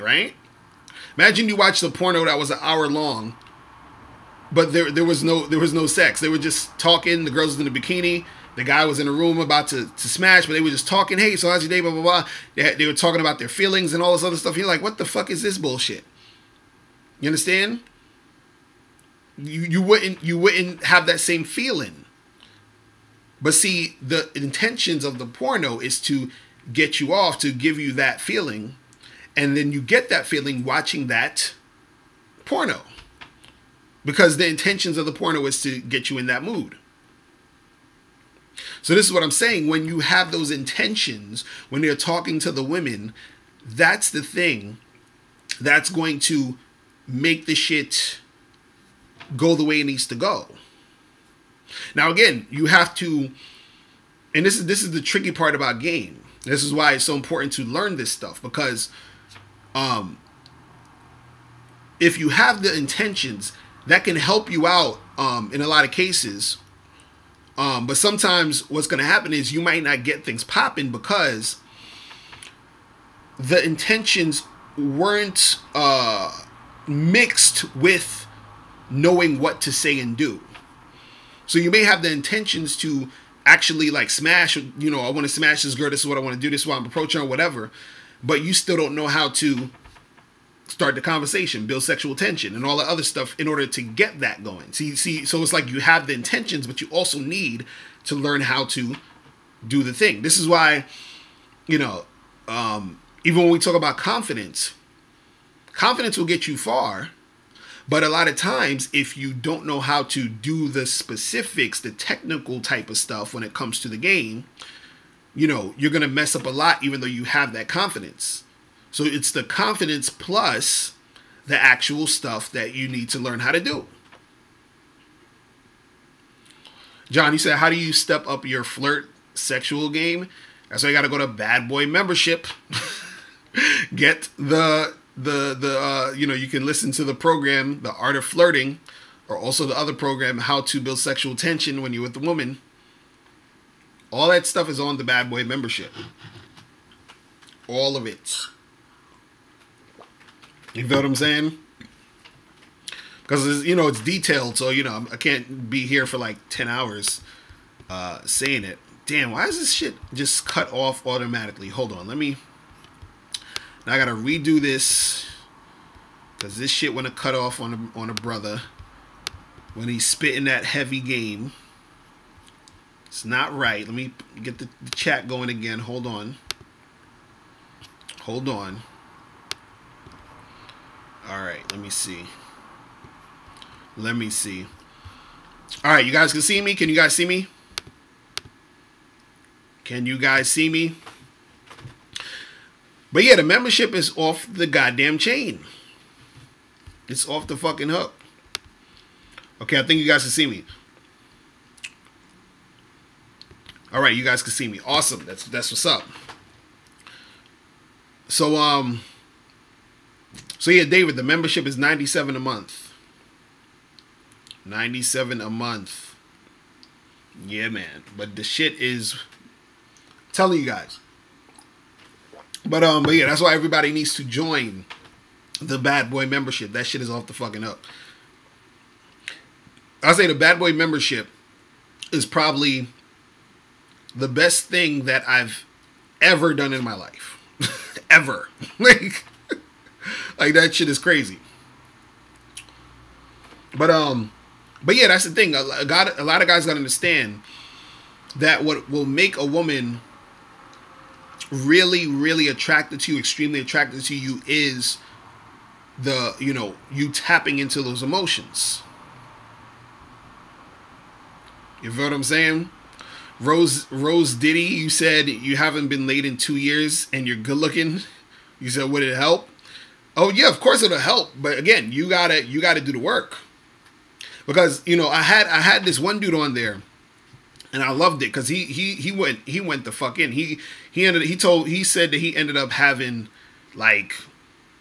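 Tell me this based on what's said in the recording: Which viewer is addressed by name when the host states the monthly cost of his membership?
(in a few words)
David.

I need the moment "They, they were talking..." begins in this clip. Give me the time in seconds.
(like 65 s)
12 s.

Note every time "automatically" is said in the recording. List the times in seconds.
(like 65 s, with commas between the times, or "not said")
161 s.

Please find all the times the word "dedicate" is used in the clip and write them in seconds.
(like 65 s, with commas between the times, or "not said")
not said.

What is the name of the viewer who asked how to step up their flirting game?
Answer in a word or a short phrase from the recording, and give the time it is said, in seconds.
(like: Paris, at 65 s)
John, at 127 s.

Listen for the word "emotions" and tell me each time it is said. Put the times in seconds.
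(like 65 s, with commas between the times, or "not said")
258 s.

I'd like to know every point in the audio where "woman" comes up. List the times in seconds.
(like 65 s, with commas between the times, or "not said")
142 s, 249 s.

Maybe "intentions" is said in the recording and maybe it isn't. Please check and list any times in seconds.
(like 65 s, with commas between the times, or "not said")
24 s, 34 s, 40 s, 62 s, 73 s, 82 s, 96 s.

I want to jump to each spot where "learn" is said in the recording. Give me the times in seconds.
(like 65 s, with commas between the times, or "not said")
57 s, 98 s, 123 s.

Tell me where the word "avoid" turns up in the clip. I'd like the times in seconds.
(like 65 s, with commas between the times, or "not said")
not said.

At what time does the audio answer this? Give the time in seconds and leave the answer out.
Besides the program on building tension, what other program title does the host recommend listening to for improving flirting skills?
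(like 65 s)
137 s.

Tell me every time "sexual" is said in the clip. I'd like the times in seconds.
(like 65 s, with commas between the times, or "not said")
91 s, 129 s, 140 s.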